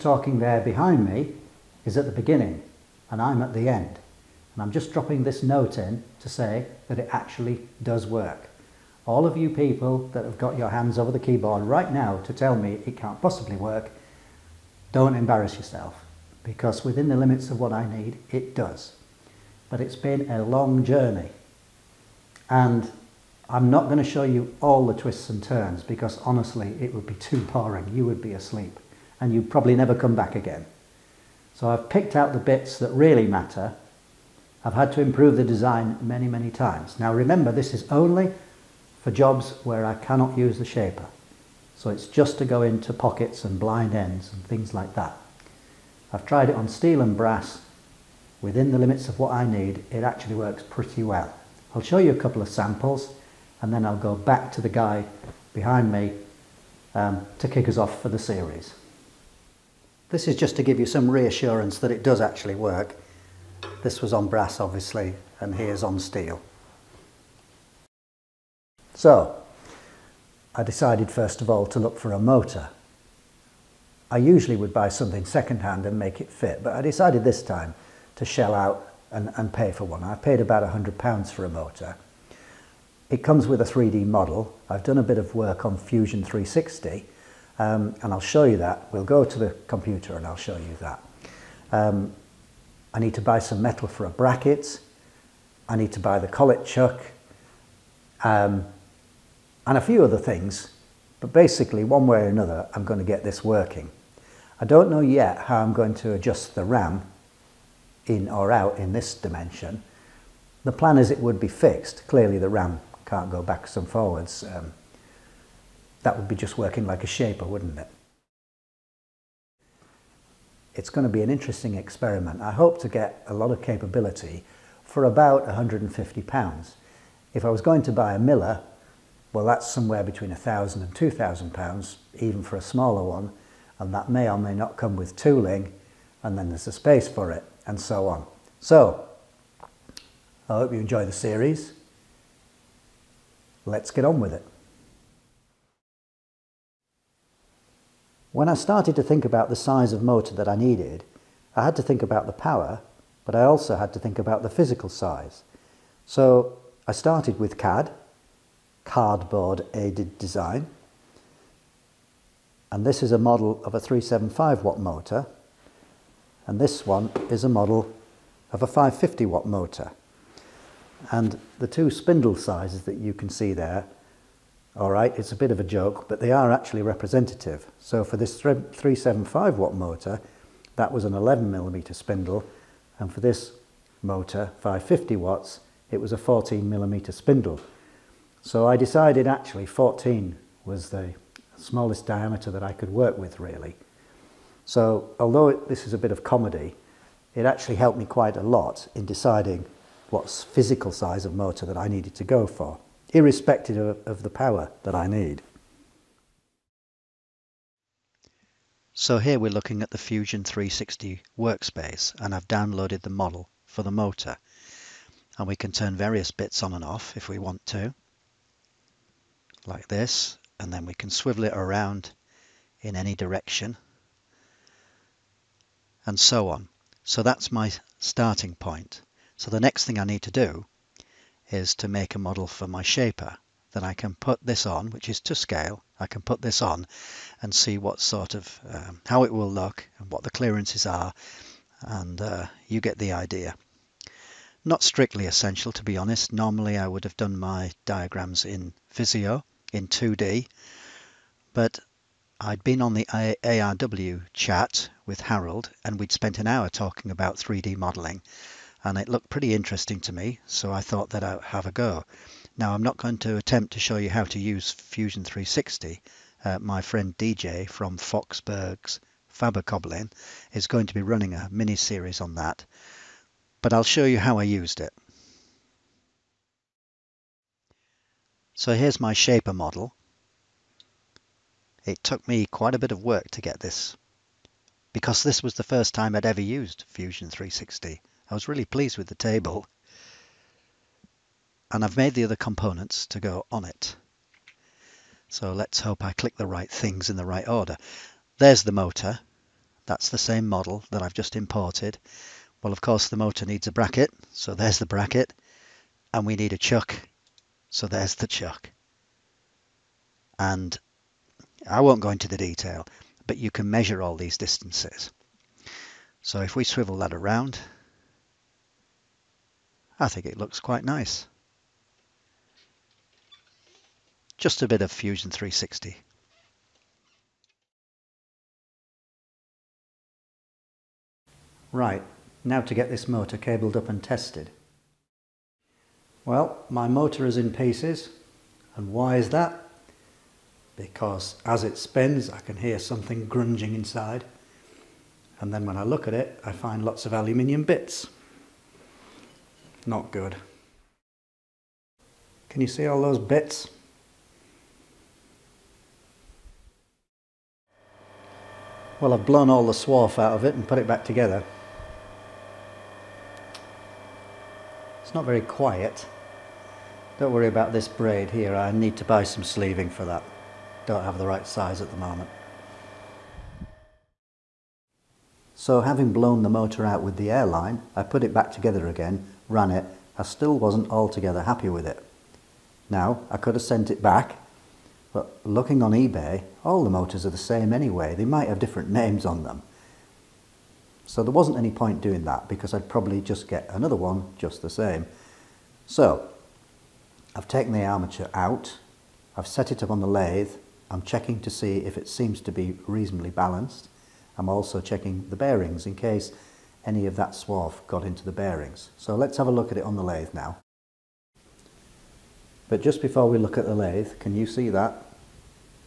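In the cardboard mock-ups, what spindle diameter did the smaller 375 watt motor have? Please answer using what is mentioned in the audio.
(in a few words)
11 millimeters.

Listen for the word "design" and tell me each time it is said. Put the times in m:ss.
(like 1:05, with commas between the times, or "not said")
0:35, 2:40.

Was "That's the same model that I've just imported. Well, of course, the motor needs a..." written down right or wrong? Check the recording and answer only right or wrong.
right.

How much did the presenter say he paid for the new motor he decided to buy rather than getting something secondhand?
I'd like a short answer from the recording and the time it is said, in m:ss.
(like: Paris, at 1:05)
£100, at 1:20.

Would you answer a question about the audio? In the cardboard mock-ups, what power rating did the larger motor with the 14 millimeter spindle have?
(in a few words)
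550 watts.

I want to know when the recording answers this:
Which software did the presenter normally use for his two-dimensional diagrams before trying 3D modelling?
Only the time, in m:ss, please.
4:08.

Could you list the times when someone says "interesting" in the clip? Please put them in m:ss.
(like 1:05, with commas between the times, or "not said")
2:01, 4:19.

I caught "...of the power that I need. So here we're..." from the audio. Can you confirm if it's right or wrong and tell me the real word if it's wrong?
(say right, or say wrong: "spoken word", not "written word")
right.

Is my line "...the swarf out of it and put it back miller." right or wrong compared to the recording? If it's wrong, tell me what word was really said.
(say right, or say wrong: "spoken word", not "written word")
wrong: "together", not "miller".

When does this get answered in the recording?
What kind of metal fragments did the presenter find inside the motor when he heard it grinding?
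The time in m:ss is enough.
5:47.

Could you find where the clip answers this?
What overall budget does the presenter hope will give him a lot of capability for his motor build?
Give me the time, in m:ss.
2:05.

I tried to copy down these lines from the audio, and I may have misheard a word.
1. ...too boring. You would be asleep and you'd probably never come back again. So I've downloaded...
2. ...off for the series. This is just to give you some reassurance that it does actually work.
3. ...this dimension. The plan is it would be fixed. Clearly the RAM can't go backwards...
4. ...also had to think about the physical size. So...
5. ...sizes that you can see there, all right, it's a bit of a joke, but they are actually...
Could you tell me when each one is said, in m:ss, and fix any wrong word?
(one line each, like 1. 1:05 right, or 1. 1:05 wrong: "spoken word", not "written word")
1. 0:27 wrong: "picked", not "downloaded"
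2. 0:57 right
3. 1:48 right
4. 2:33 right
5. 2:52 right.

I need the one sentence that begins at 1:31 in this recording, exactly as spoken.
Um, I need to buy some metal for a bracket.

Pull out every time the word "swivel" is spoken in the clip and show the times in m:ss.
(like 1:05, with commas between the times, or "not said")
3:41, 5:16.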